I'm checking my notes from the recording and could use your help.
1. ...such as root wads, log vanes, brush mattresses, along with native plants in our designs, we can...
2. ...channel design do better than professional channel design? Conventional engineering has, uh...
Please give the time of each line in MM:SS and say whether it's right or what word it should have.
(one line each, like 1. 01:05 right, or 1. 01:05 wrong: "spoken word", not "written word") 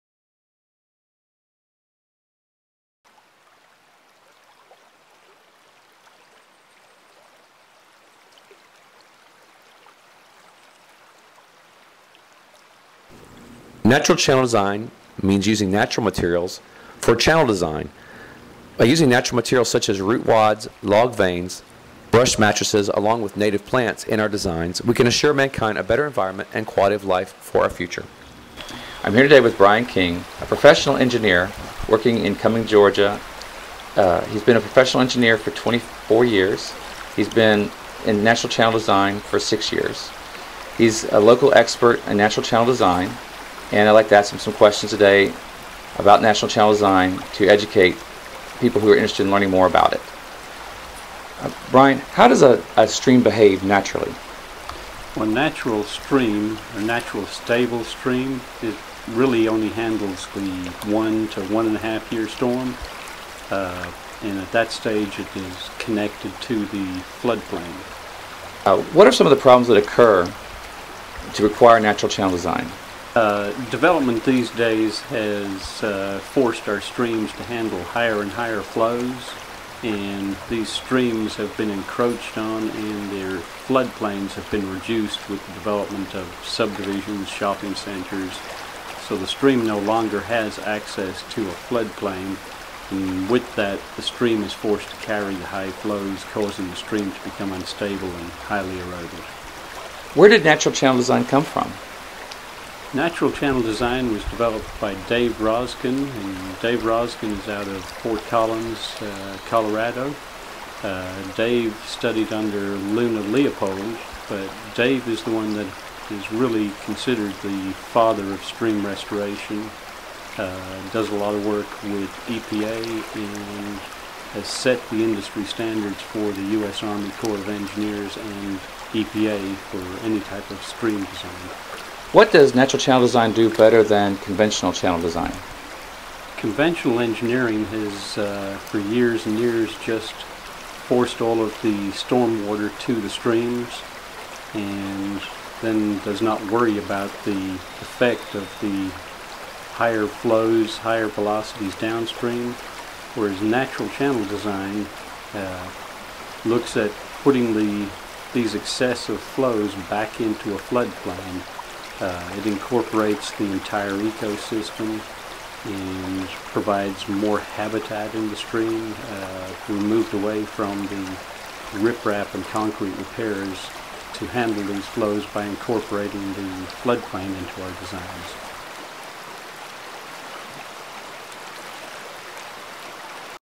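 1. 00:19 right
2. 02:12 wrong: "conventional", not "professional".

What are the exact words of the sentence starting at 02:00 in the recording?
Uh, does a lot of work with EPA and has set the industry standards for the U.S.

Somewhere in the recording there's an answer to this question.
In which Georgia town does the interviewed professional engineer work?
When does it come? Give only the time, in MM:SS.
00:32.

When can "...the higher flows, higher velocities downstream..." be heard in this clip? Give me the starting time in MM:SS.
02:28.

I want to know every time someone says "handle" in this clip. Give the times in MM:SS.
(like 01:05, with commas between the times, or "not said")
00:59, 01:17, 02:54.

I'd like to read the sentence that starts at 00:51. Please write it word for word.
Uh, Brian, how does a, a stream behave naturally?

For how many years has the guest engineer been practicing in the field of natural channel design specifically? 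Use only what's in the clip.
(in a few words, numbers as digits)
6 years.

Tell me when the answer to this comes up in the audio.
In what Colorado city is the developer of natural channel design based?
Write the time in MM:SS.
01:47.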